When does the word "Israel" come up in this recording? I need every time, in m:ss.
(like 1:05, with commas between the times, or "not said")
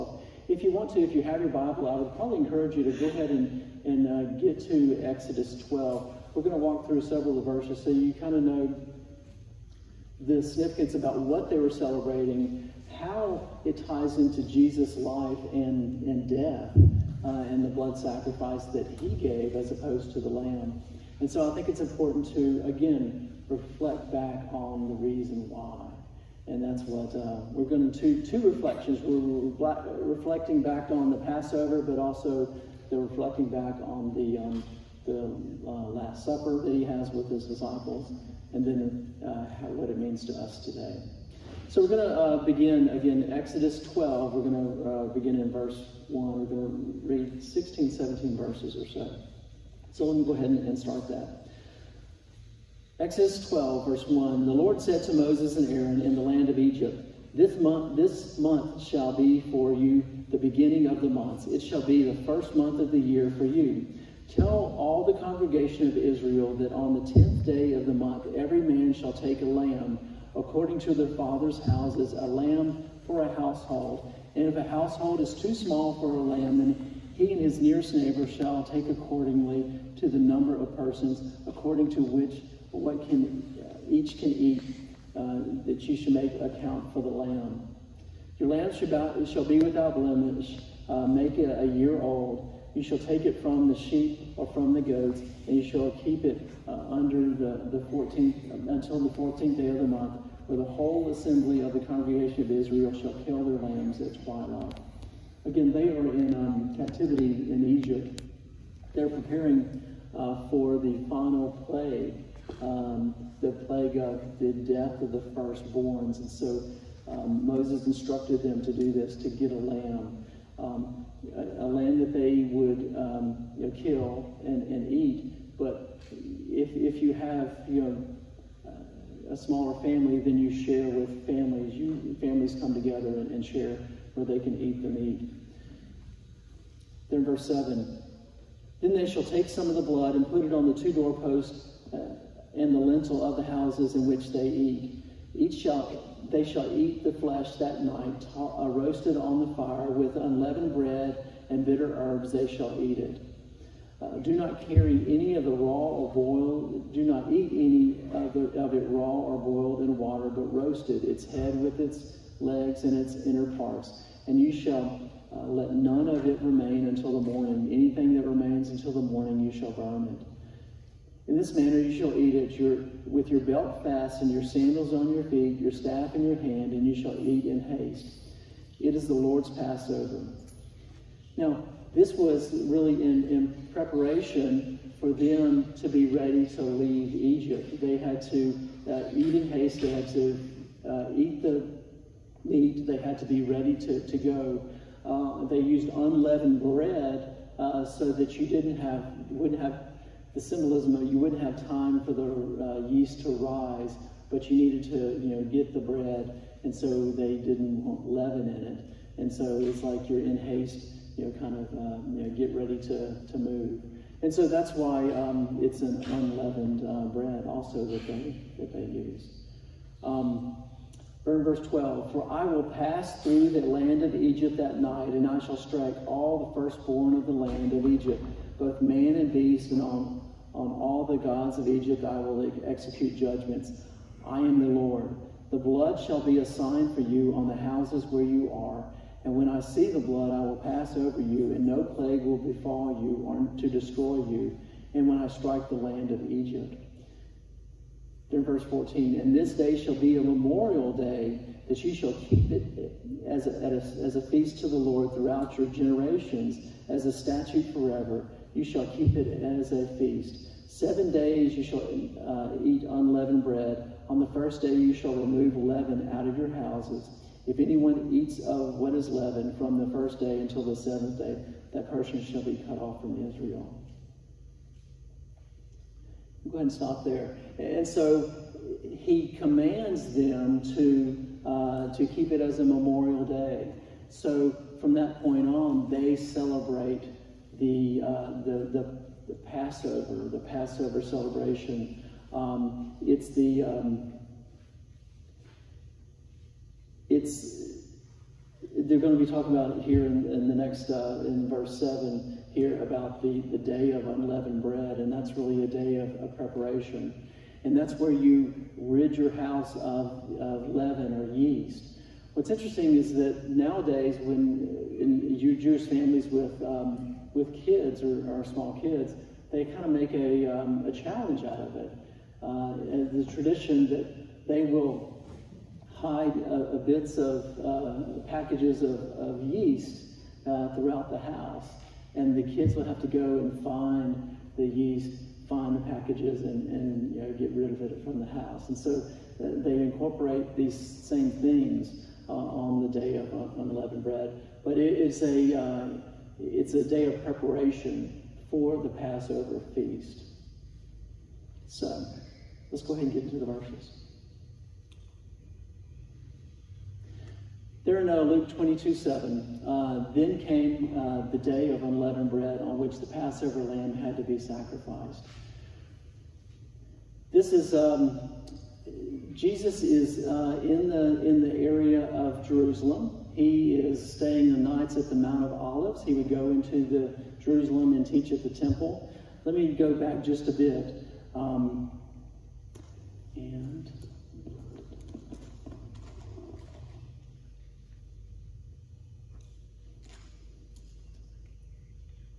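1:05, 1:42, 4:33.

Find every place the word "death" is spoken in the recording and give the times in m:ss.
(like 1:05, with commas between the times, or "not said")
0:16, 1:54.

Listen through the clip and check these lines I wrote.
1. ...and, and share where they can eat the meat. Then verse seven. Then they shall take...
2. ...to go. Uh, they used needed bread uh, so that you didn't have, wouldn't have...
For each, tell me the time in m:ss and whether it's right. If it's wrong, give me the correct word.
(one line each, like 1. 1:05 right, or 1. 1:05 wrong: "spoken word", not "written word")
1. 2:13 right
2. 3:13 wrong: "unleavened", not "needed".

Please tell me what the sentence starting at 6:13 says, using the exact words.
He is staying the nights at the Mount of Olives.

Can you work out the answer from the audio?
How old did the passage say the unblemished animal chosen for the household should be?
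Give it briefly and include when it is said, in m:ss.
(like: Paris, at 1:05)
a year old, at 1:31.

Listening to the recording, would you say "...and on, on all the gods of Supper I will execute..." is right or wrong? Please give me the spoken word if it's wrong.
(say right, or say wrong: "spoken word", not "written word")
wrong: "Egypt", not "Supper".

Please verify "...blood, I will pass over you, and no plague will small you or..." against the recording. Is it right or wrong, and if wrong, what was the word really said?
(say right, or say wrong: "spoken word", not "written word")
wrong: "befall", not "small".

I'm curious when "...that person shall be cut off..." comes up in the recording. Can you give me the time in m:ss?
4:31.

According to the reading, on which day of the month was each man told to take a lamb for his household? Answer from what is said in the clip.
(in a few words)
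10th day.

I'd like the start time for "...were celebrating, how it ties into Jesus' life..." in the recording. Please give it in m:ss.
0:11.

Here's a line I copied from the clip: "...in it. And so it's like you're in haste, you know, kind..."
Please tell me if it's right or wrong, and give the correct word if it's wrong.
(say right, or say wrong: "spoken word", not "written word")
right.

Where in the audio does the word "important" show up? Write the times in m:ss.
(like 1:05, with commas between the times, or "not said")
0:21.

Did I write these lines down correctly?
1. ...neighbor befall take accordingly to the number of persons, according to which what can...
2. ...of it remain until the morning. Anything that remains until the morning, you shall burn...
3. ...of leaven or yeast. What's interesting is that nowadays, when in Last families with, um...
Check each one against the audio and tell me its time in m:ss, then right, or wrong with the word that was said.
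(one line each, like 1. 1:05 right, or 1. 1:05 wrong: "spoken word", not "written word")
1. 1:17 wrong: "shall", not "befall"
2. 2:46 right
3. 5:10 wrong: "Jewish", not "Last".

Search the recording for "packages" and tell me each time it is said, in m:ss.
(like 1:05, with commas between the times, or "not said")
5:28, 5:35.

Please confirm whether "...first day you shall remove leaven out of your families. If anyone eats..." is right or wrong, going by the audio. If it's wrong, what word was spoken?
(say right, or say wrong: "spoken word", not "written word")
wrong: "houses", not "families".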